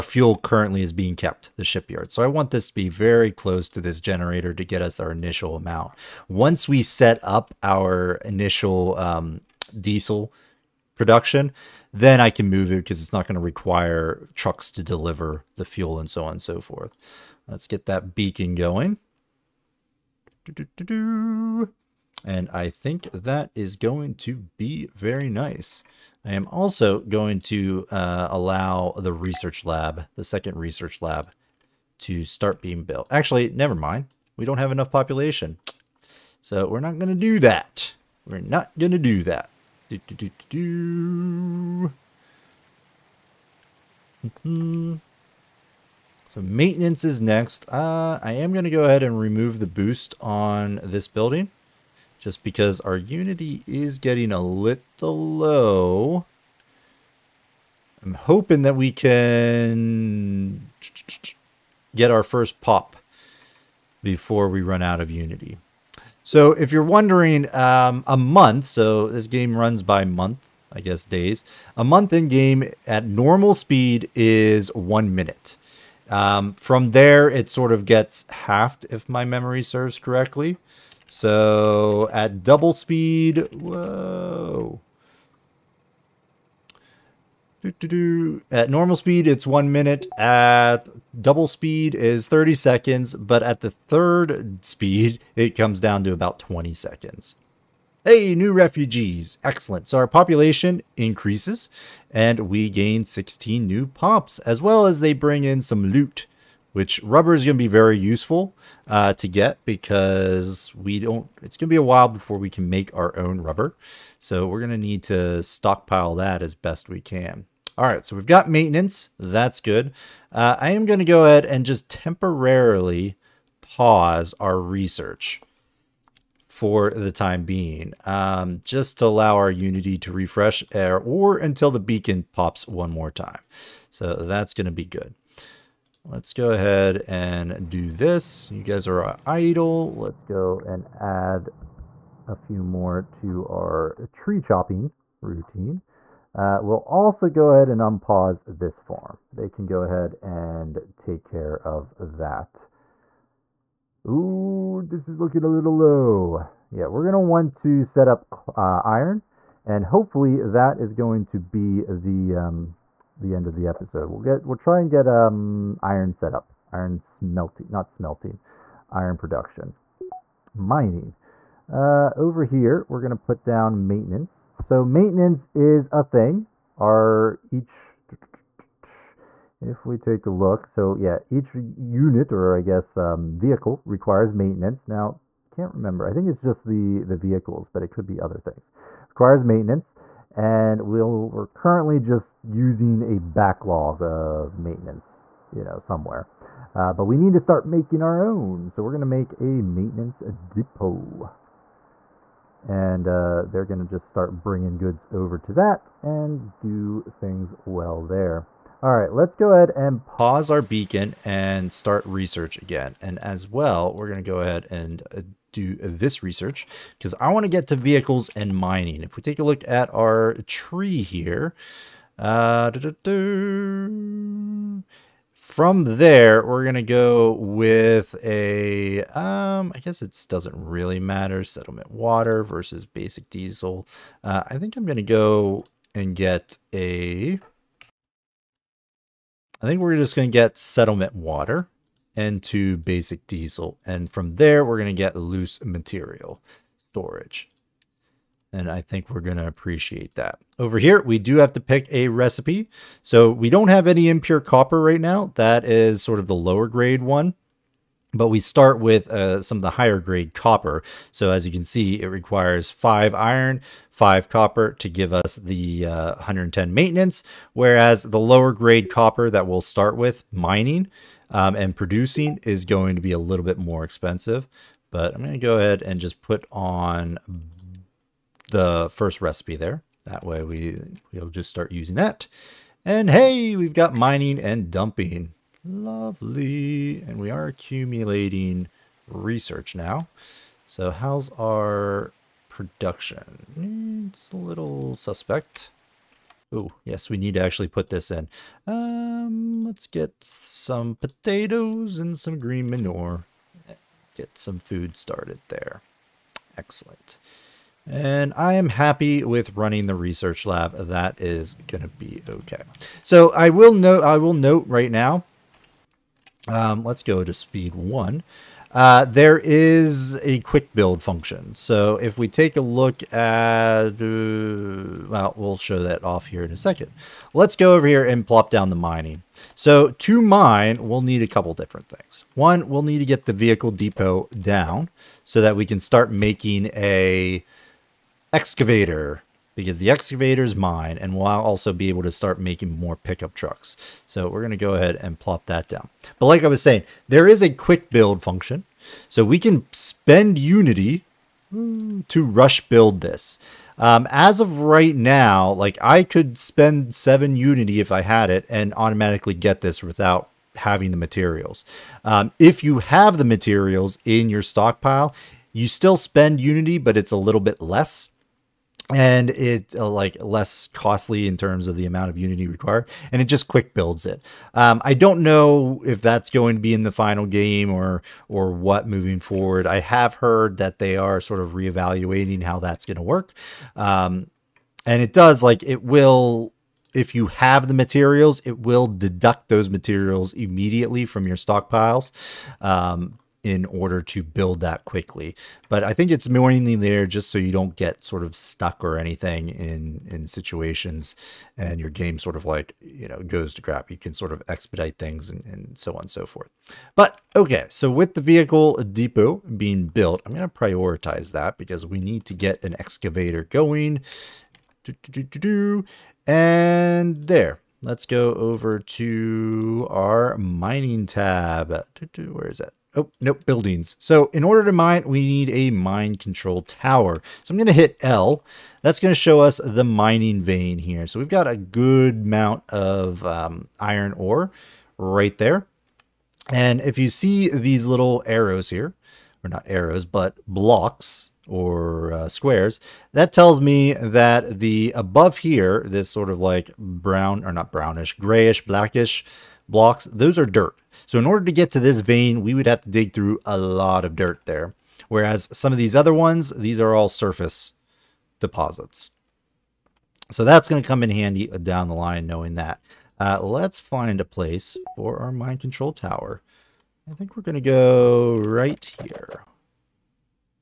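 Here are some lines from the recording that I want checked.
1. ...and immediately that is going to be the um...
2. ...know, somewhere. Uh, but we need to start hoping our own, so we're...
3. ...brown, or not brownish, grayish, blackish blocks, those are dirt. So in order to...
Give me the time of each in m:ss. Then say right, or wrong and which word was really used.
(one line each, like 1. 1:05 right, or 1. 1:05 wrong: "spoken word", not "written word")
1. 2:39 wrong: "hopefully", not "immediately"
2. 3:15 wrong: "making", not "hoping"
3. 7:26 right.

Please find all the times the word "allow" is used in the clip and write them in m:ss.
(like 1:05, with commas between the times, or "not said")
0:28, 2:09.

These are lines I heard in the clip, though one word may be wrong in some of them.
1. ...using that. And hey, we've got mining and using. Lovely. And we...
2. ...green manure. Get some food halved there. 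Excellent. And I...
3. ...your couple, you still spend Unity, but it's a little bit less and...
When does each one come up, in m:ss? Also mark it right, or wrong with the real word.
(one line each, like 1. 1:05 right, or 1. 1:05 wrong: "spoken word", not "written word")
1. 4:41 wrong: "dumping", not "using"
2. 5:02 wrong: "started", not "halved"
3. 6:04 wrong: "stockpile", not "couple".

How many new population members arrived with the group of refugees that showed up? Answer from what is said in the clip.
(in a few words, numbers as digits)
16.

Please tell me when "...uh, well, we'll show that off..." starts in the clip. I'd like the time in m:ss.
5:23.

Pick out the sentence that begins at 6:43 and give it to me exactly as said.
You can sort of expedite things and, and so on and so forth.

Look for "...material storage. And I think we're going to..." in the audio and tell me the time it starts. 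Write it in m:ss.
4:05.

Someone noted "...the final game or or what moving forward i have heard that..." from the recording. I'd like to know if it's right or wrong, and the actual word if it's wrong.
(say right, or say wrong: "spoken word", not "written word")
right.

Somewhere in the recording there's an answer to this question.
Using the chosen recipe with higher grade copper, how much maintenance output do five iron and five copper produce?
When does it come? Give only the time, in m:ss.
4:26.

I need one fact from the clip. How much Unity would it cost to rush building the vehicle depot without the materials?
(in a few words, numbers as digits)
7.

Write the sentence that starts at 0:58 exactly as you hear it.
I'm hoping that we can get our first pop before we run out of unity.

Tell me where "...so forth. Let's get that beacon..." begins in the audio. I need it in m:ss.
0:16.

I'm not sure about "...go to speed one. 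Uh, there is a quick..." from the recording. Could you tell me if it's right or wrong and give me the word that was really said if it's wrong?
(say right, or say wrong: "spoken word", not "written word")
right.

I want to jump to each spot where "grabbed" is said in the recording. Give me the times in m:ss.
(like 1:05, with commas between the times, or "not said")
not said.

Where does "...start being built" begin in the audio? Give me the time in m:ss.
0:32.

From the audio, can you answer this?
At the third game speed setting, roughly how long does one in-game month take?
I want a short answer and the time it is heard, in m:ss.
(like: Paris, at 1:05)
About 20 seconds, at 1:36.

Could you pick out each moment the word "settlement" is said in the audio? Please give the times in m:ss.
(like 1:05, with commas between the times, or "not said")
3:51, 4:00.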